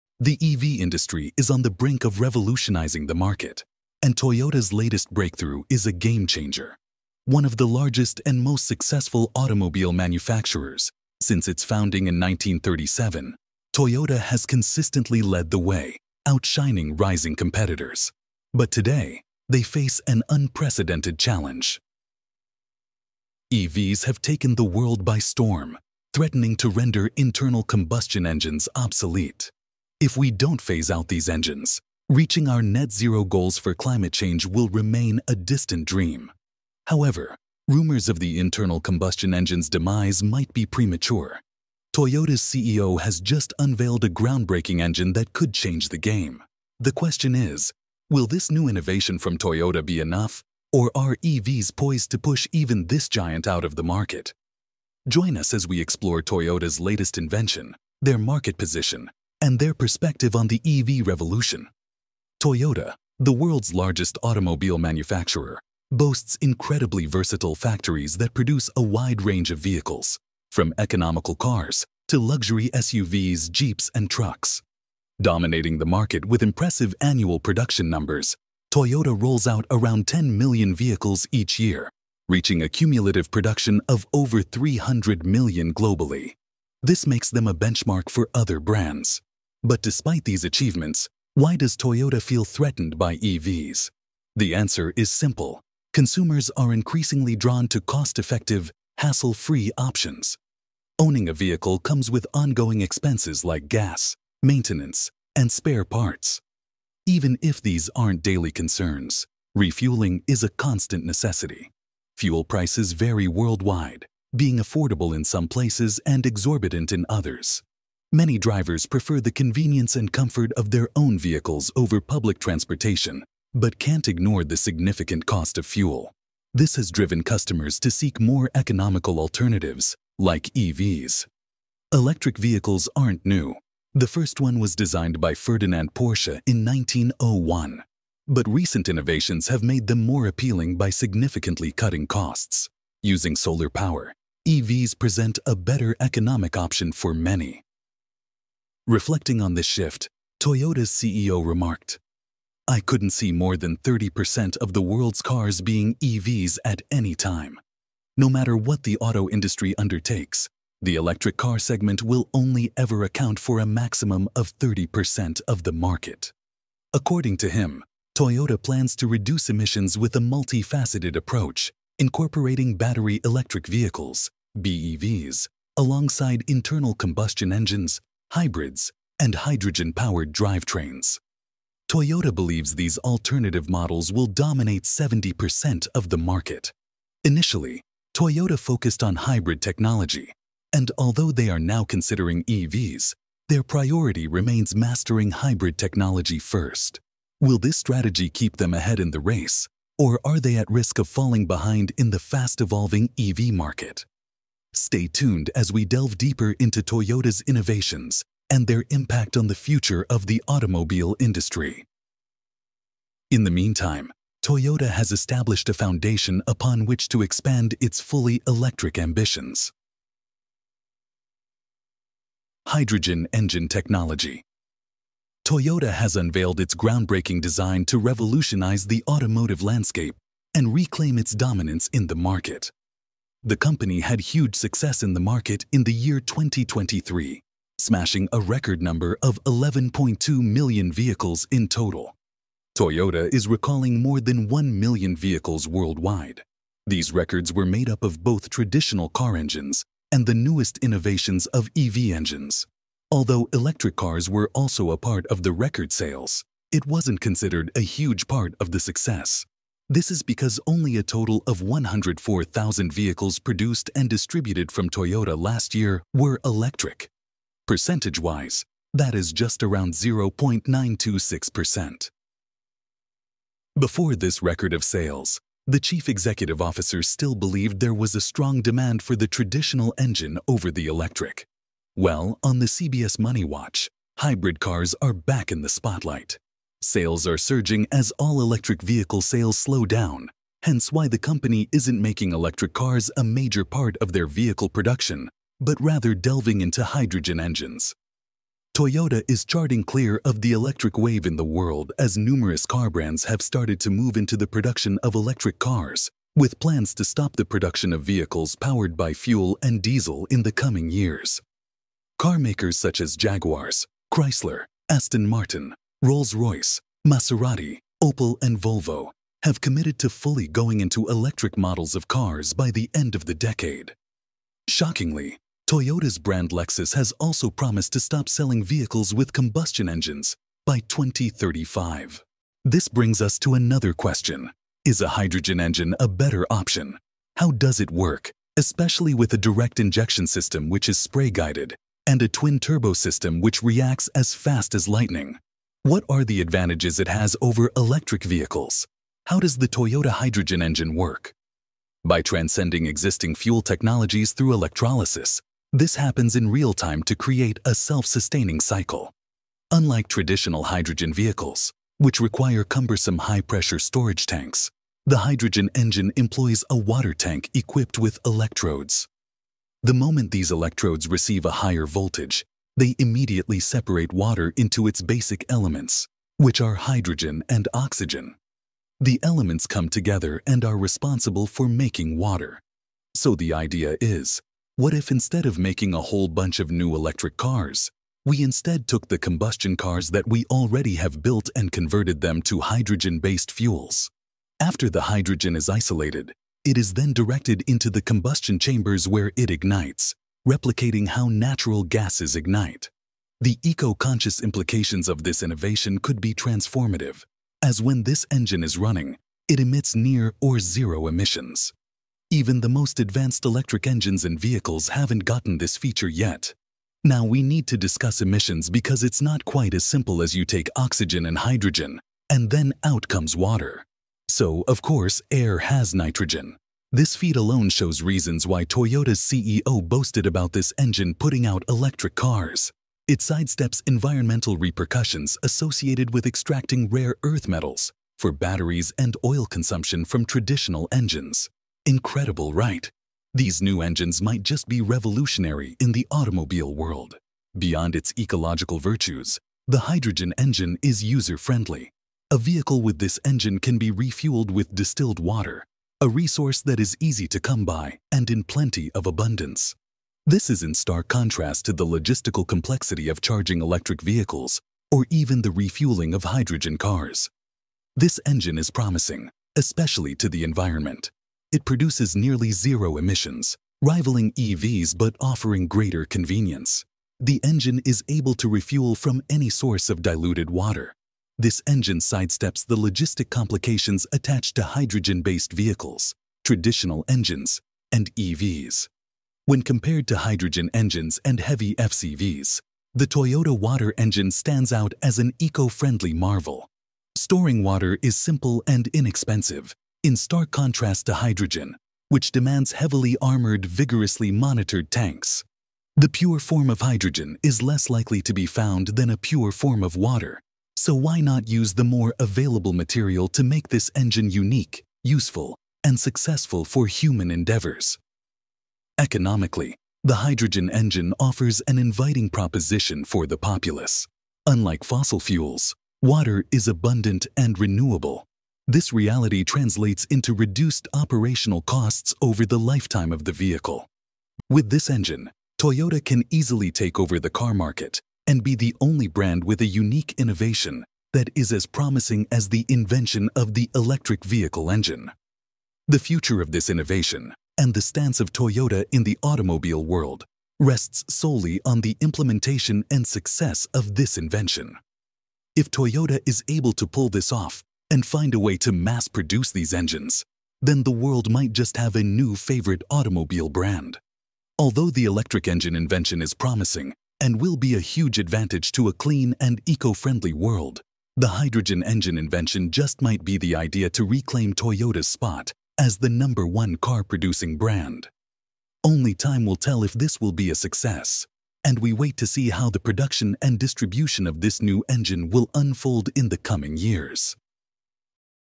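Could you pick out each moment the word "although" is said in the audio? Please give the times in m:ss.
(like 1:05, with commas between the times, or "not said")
3:10, 4:13, 9:24.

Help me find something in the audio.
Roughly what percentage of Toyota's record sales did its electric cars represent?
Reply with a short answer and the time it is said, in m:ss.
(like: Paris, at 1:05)
0.926%, at 4:29.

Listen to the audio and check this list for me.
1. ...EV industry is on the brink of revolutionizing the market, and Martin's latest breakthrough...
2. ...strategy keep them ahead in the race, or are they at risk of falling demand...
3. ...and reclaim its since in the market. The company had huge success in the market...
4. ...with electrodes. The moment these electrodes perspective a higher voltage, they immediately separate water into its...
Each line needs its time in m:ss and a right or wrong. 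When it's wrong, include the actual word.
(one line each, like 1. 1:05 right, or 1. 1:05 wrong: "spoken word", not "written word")
1. 0:00 wrong: "Toyota", not "Martin"
2. 3:17 wrong: "behind", not "demand"
3. 3:50 wrong: "dominance", not "since"
4. 6:07 wrong: "receive", not "perspective".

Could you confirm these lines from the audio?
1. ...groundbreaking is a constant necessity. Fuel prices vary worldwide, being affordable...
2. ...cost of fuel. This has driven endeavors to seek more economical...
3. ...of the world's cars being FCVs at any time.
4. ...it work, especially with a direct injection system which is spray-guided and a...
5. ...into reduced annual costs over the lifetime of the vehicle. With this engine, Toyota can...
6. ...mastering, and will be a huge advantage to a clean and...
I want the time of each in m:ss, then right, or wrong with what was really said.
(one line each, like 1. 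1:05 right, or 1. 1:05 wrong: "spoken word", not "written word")
1. 1:49 wrong: "refueling", not "groundbreaking"
2. 2:05 wrong: "customers", not "endeavors"
3. 2:34 wrong: "EVs", not "FCVs"
4. 5:37 right
5. 8:50 wrong: "operational", not "annual"
6. 9:26 wrong: "promising", not "mastering".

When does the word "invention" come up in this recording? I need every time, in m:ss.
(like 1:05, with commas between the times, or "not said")
0:57, 9:02, 9:14, 9:25, 9:32.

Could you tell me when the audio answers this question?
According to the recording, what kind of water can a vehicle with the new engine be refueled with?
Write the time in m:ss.
7:34.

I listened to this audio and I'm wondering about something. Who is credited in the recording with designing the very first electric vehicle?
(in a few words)
Ferdinand Porsche.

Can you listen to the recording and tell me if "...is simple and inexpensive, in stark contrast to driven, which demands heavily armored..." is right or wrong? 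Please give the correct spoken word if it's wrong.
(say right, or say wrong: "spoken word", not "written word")
wrong: "hydrogen", not "driven".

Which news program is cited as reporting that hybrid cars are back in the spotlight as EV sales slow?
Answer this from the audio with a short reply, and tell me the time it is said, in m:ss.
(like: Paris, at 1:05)
CBS Money Watch, at 4:42.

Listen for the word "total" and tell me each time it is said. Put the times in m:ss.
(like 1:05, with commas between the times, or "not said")
4:01, 4:21.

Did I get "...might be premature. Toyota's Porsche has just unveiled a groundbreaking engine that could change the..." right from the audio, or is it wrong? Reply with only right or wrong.
wrong.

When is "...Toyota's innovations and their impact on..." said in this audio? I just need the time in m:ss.
3:26.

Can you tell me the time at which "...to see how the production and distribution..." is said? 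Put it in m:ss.
9:42.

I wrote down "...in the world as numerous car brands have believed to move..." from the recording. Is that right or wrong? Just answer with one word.
wrong.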